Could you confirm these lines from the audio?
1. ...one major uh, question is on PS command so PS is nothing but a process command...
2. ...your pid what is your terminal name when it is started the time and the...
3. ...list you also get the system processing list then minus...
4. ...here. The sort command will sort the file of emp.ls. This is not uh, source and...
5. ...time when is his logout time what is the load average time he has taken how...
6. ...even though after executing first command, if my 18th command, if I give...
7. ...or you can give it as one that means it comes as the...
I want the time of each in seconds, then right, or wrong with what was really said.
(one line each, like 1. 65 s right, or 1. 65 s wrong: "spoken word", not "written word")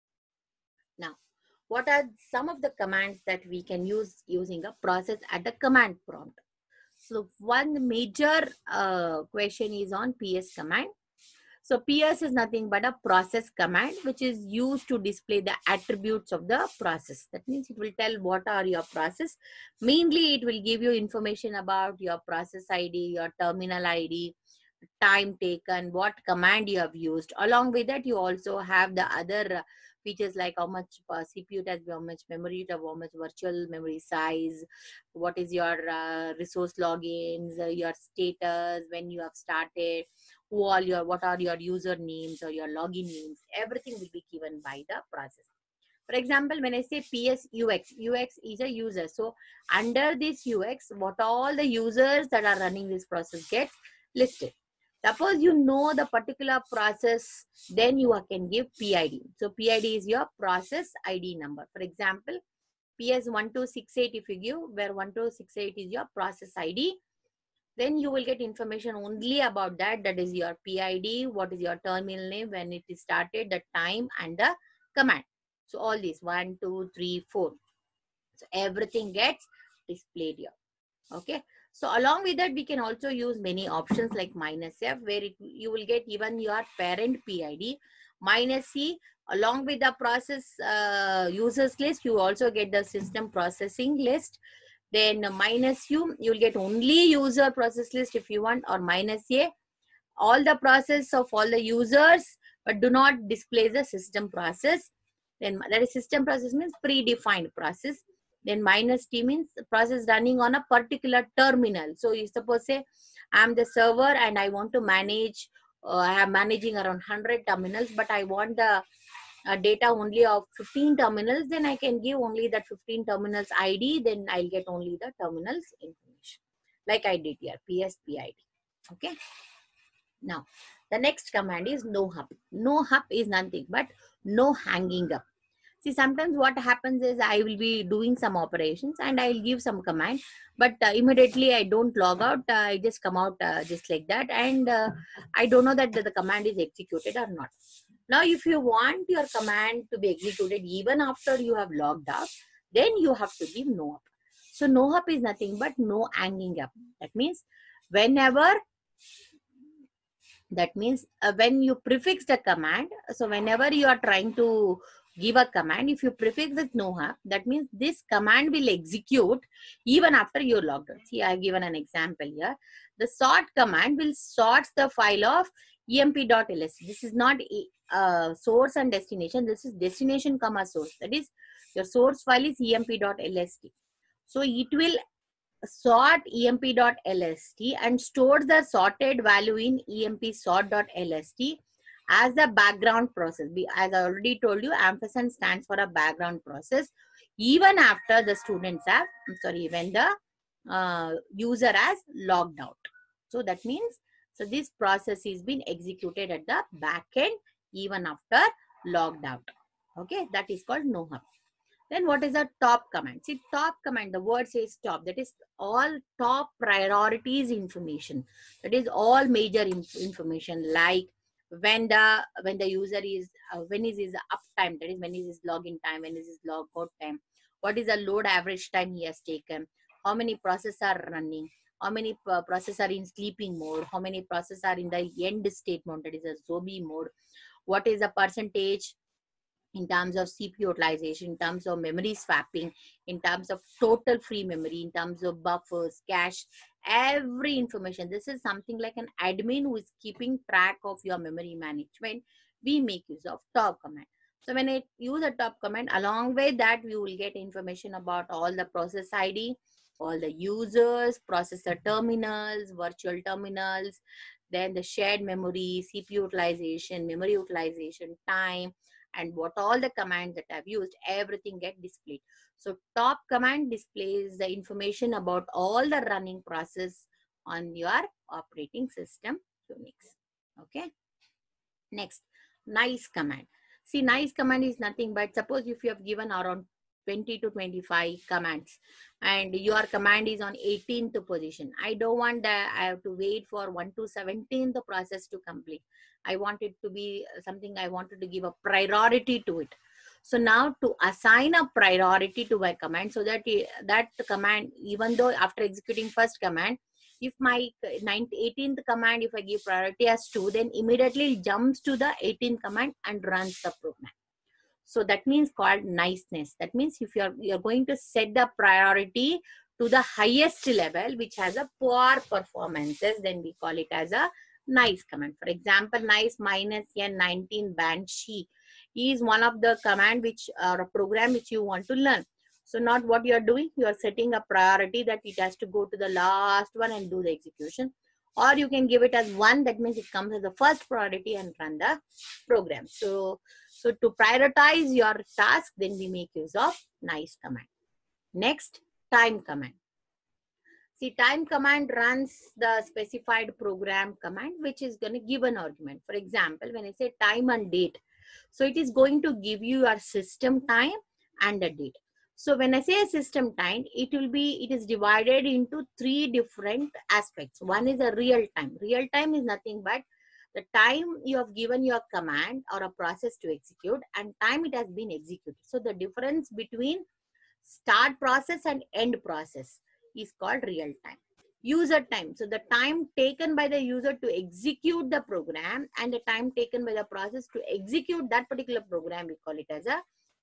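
1. 7 s right
2. 70 s right
3. 91 s right
4. 172 s right
5. 225 s right
6. 304 s right
7. 338 s right.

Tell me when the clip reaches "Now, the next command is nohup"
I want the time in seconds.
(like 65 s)
130 s.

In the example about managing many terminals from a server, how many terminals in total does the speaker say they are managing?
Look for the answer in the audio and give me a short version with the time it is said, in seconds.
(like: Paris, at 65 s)
100, at 117 s.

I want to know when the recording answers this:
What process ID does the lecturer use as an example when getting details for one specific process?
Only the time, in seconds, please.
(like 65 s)
65 s.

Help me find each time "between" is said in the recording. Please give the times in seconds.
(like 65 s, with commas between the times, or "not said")
376 s.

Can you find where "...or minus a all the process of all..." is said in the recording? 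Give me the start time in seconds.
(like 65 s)
98 s.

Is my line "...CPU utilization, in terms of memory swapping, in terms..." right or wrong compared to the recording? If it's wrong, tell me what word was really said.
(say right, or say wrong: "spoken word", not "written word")
right.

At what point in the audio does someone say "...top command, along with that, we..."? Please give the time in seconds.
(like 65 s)
255 s.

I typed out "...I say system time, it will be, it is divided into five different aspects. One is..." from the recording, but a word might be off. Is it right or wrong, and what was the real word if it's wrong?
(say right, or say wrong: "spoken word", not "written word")
wrong: "three", not "five".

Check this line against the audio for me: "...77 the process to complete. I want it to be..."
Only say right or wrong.
wrong.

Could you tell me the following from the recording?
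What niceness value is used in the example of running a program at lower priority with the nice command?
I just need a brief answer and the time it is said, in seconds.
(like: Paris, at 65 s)
19, at 327 s.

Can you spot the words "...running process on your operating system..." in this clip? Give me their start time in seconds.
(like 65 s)
276 s.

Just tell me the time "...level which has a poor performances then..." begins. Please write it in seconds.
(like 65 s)
320 s.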